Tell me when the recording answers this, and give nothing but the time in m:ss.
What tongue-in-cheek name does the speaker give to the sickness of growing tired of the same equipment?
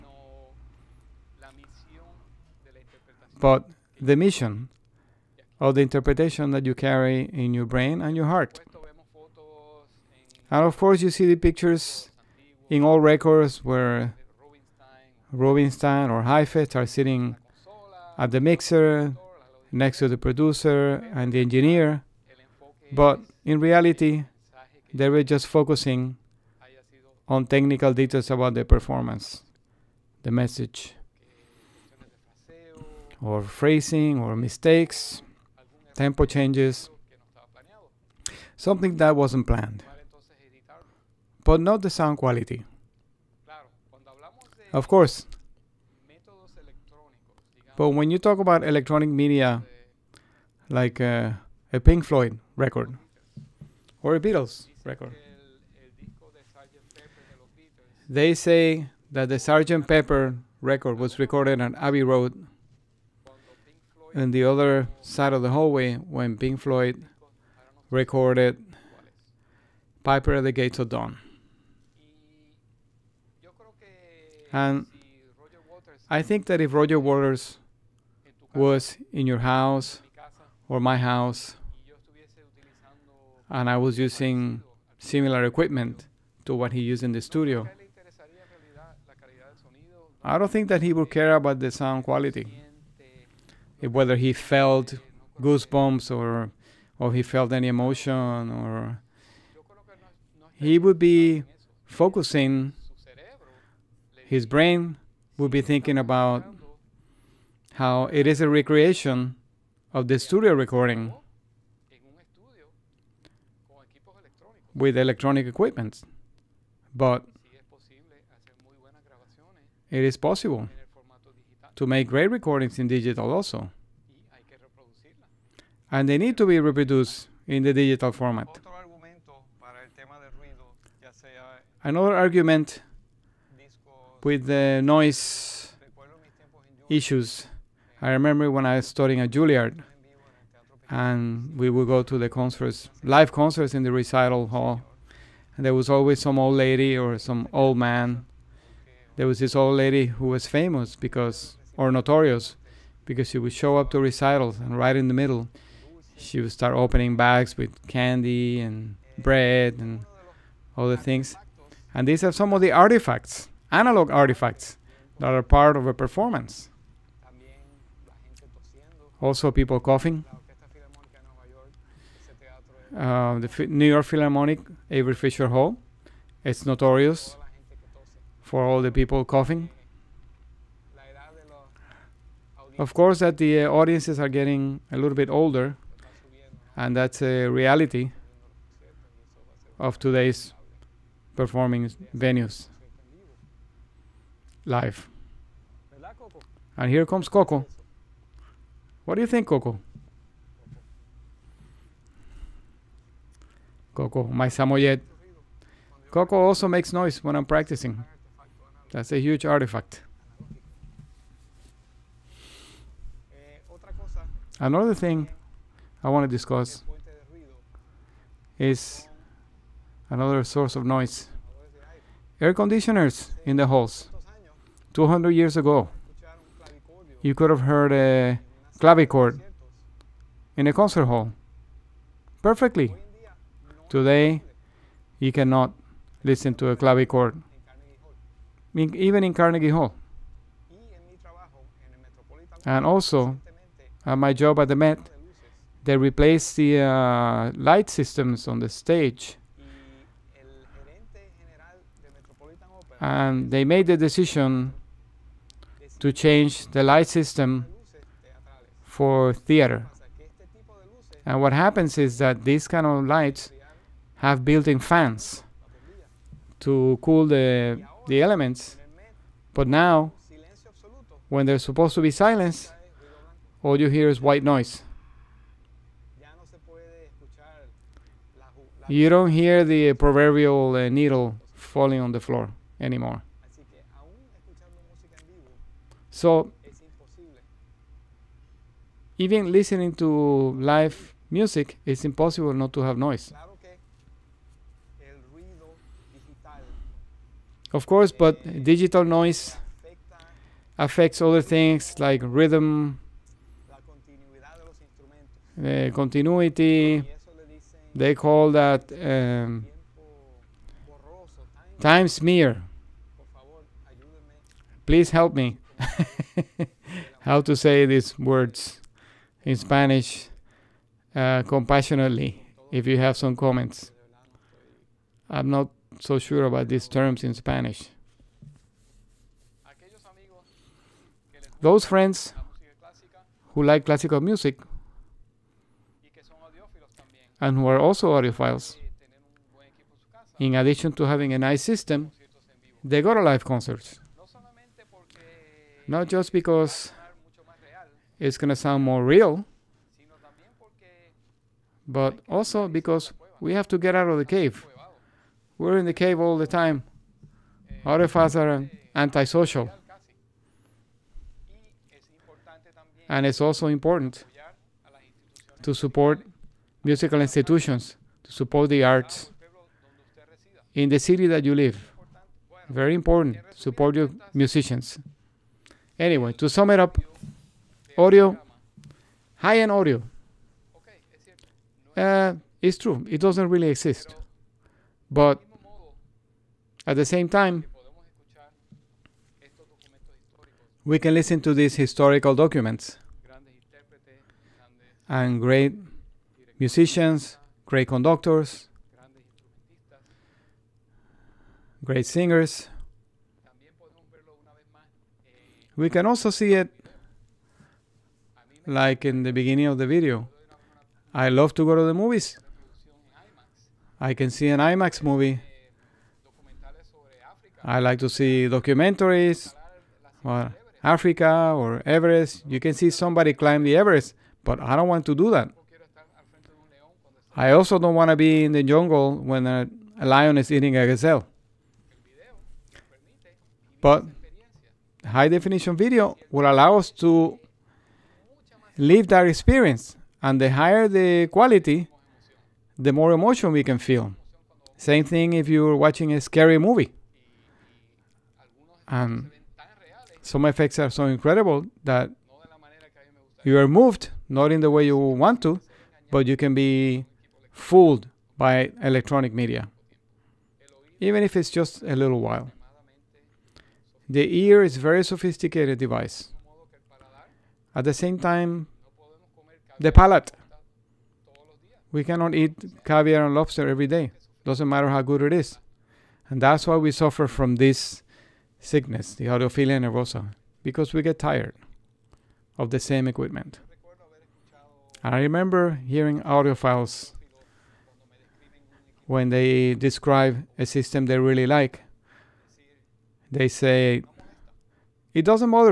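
7:59.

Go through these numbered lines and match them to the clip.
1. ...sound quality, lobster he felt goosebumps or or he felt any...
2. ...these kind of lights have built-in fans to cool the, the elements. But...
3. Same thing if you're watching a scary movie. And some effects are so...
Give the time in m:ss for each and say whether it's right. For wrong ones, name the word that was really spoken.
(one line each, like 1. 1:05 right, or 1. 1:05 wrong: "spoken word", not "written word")
1. 1:31 wrong: "whether", not "lobster"
2. 4:22 right
3. 7:24 right.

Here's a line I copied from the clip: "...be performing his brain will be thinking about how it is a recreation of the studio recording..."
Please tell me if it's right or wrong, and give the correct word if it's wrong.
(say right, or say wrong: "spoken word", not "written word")
wrong: "focusing", not "performing".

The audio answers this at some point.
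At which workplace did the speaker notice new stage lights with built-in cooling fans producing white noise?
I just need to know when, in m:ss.
4:04.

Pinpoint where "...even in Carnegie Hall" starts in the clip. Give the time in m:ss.
3:58.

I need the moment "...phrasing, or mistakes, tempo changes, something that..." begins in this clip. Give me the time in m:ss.
0:33.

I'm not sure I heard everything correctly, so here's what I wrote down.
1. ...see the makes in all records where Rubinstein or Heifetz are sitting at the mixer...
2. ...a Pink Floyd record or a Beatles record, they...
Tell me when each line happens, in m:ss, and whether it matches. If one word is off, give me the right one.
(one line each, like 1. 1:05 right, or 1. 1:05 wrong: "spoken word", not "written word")
1. 0:11 wrong: "pictures", not "makes"
2. 0:51 right.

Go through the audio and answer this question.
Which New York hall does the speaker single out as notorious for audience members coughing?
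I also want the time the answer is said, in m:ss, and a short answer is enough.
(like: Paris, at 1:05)
Avery Fisher Hall, at 2:54.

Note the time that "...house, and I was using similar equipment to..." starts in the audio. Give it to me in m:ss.
1:20.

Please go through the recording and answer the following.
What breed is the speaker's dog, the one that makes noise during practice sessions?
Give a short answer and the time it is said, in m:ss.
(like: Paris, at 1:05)
Samoyed, at 3:24.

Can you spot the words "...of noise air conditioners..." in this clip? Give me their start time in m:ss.
3:40.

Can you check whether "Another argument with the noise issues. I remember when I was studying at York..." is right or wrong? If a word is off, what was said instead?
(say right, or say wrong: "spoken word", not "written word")
wrong: "Juilliard", not "York".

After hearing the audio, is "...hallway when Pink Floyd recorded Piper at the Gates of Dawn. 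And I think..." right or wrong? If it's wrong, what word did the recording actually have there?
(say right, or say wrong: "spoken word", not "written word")
right.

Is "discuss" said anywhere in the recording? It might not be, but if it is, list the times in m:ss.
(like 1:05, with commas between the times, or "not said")
3:36.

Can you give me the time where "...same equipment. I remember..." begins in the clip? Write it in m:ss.
8:02.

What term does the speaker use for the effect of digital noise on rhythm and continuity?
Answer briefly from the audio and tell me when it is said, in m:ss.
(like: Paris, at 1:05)
time smear, at 5:11.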